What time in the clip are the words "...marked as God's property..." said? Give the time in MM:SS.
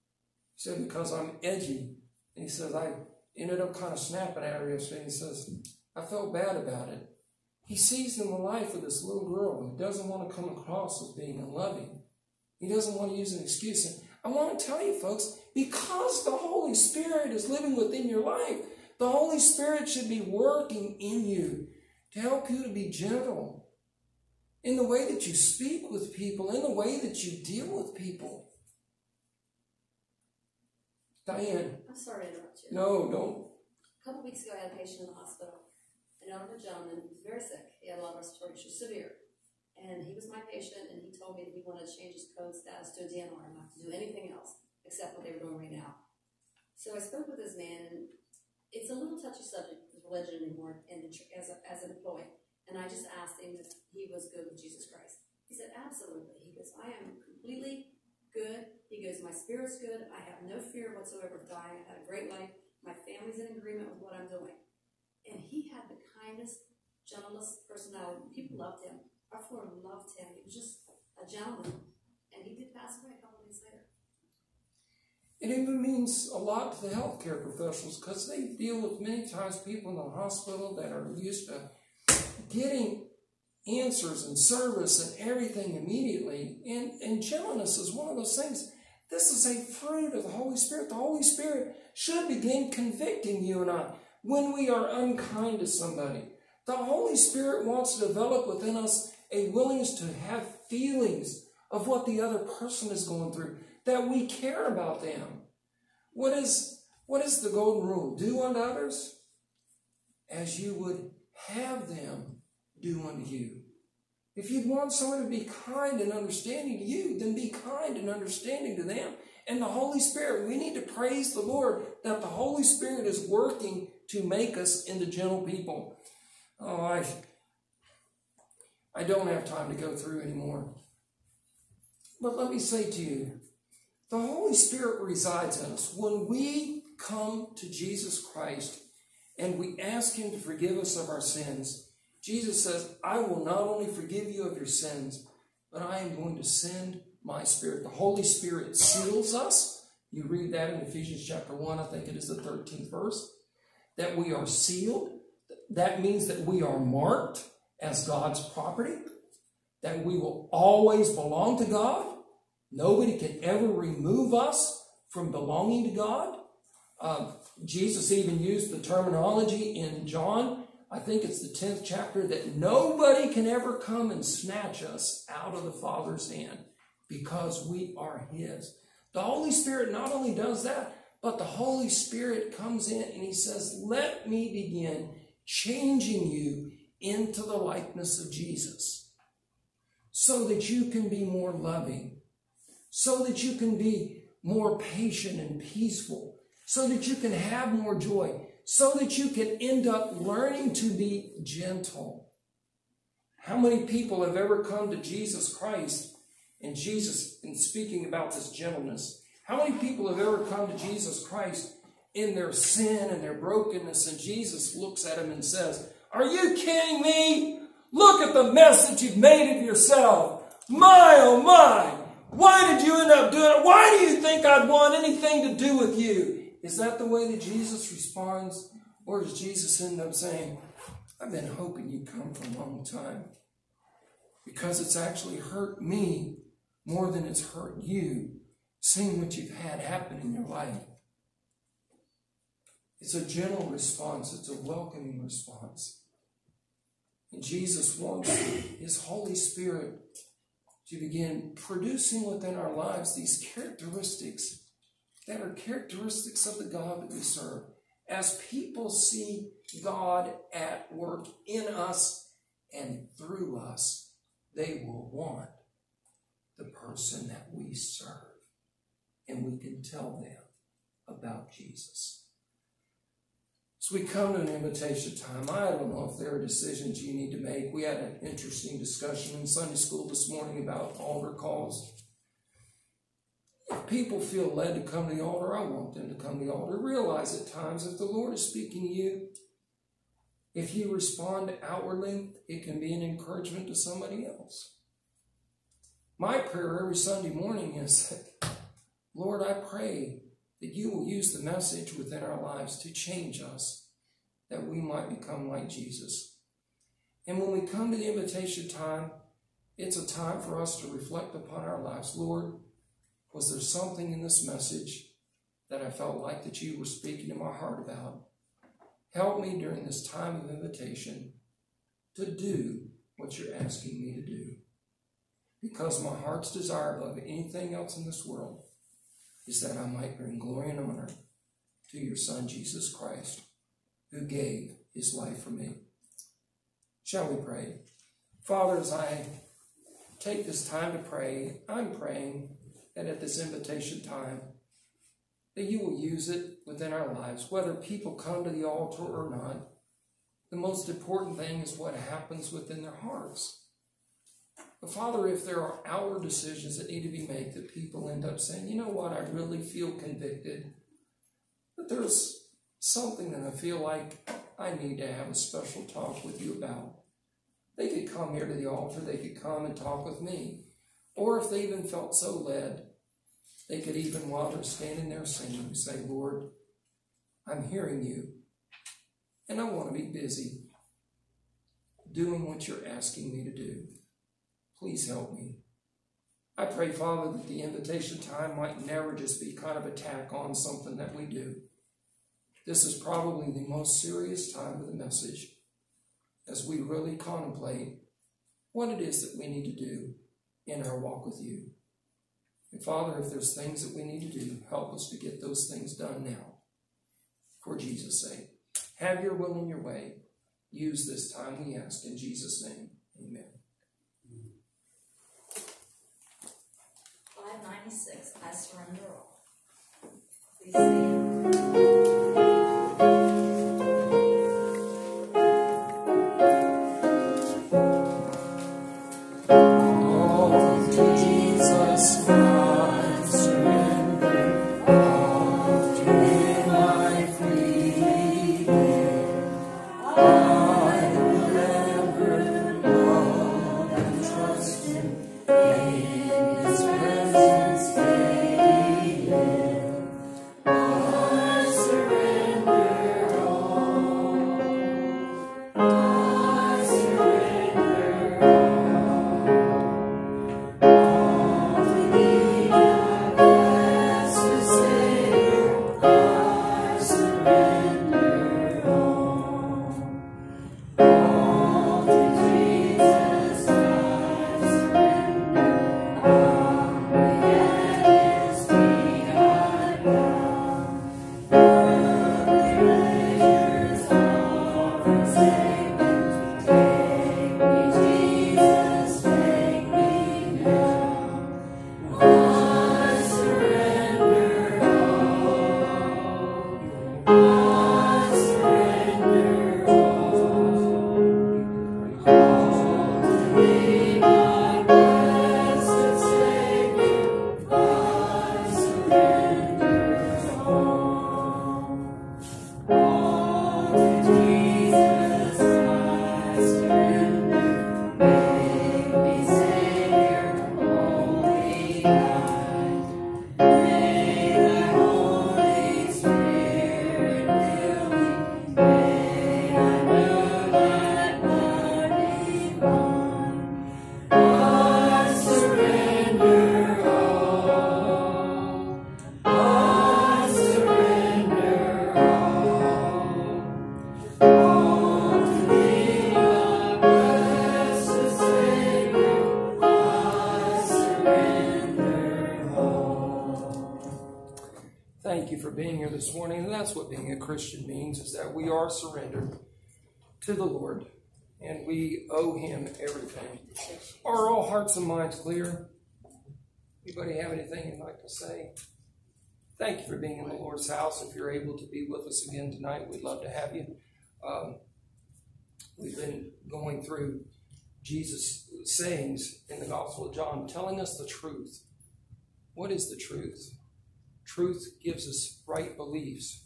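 02:36.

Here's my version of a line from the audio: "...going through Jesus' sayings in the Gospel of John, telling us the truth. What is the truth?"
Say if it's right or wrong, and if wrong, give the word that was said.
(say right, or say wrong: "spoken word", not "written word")
right.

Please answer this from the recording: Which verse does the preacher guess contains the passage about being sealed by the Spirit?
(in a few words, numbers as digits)
13th.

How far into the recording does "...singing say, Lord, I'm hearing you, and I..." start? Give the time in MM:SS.
06:15.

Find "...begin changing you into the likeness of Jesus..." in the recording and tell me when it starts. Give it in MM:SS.
03:04.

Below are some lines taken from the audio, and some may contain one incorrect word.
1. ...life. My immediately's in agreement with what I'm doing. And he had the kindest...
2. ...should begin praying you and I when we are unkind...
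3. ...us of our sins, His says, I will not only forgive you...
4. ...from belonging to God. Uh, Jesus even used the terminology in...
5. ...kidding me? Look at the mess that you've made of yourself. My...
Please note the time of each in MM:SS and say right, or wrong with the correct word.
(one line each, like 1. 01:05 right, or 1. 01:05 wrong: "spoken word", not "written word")
1. 01:02 wrong: "family", not "immediately"
2. 01:31 wrong: "convicting", not "praying"
3. 02:20 wrong: "Jesus", not "His"
4. 02:45 right
5. 03:36 right.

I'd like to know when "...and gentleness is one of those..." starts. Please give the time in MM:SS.
01:27.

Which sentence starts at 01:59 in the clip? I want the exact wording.
And the Holy Spirit, we need to praise the Lord that the Holy Spirit is working to make us into gentle people.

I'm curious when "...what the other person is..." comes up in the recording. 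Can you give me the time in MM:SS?
01:41.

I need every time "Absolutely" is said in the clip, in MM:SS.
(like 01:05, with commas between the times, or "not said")
00:55.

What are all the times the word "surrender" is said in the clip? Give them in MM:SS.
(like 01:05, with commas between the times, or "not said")
06:58, 09:19.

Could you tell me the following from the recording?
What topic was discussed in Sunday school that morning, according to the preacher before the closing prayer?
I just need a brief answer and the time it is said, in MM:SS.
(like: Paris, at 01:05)
Altar calls, at 04:40.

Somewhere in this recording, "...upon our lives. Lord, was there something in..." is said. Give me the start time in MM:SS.
05:11.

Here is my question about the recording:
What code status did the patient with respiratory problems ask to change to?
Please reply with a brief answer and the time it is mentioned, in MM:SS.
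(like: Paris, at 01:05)
DNR, at 00:43.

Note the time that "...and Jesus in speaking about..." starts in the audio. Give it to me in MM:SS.
03:26.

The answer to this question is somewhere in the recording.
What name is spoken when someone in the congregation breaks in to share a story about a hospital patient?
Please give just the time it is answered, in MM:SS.
00:31.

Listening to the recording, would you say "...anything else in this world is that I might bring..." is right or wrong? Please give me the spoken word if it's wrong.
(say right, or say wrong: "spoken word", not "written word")
right.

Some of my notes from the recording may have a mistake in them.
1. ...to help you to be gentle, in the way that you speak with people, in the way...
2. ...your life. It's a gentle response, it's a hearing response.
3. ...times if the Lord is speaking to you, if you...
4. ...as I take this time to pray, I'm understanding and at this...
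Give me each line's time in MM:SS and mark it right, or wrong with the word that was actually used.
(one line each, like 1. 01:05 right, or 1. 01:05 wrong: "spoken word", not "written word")
1. 00:22 right
2. 04:00 wrong: "welcoming", not "hearing"
3. 04:47 right
4. 05:38 wrong: "praying", not "understanding".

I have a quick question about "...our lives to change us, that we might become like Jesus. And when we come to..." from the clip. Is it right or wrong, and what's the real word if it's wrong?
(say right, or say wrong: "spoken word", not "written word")
right.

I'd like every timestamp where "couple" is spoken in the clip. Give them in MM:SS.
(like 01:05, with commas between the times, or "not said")
00:34, 01:13.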